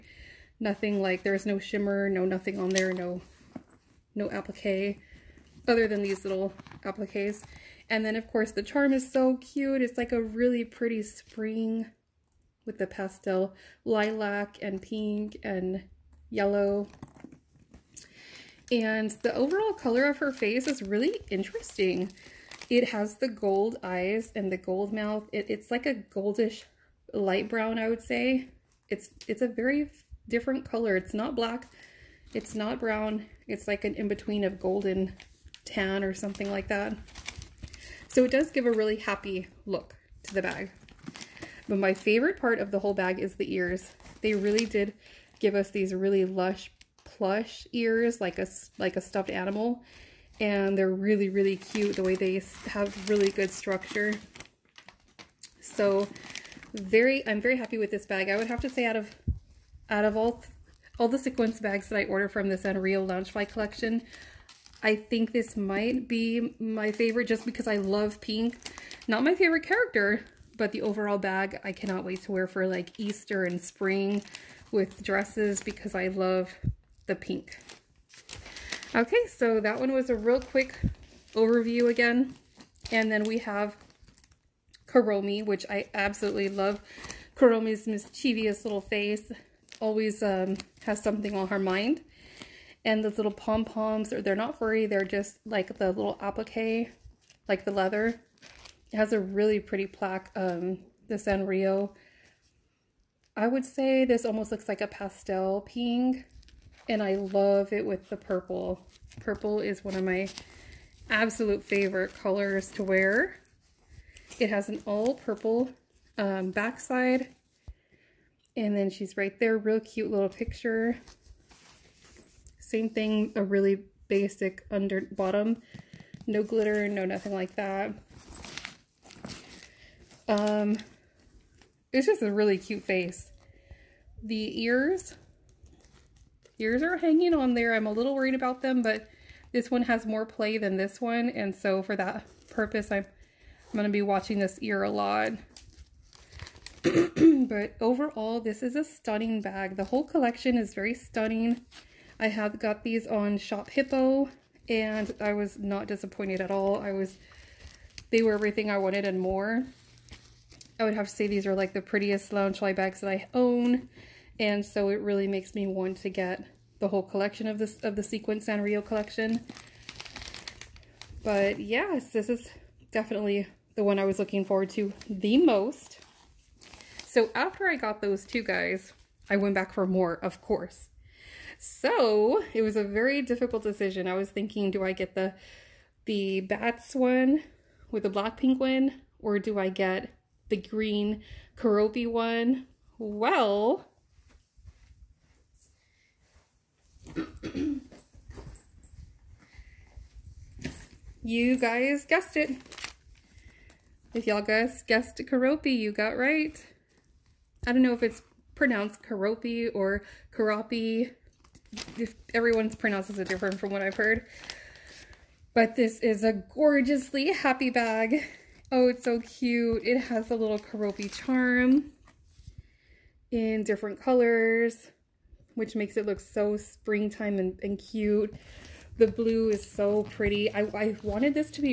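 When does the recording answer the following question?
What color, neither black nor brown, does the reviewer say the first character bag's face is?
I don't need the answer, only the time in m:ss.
0:34.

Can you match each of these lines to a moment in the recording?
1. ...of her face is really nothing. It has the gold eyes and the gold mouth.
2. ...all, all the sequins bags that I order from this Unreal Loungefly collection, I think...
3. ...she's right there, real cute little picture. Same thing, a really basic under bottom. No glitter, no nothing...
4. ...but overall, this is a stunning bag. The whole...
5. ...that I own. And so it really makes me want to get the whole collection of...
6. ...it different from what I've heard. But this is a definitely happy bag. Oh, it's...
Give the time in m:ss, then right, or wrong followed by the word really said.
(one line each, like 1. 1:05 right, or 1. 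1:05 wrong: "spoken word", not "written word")
1. 0:20 wrong: "interesting", not "nothing"
2. 1:00 right
3. 1:58 right
4. 2:26 right
5. 2:43 right
6. 3:33 wrong: "gorgeously", not "definitely".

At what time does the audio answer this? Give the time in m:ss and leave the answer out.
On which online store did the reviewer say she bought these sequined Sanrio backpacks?
2:33.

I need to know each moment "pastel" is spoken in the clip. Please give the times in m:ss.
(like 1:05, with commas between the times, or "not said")
0:12, 1:44.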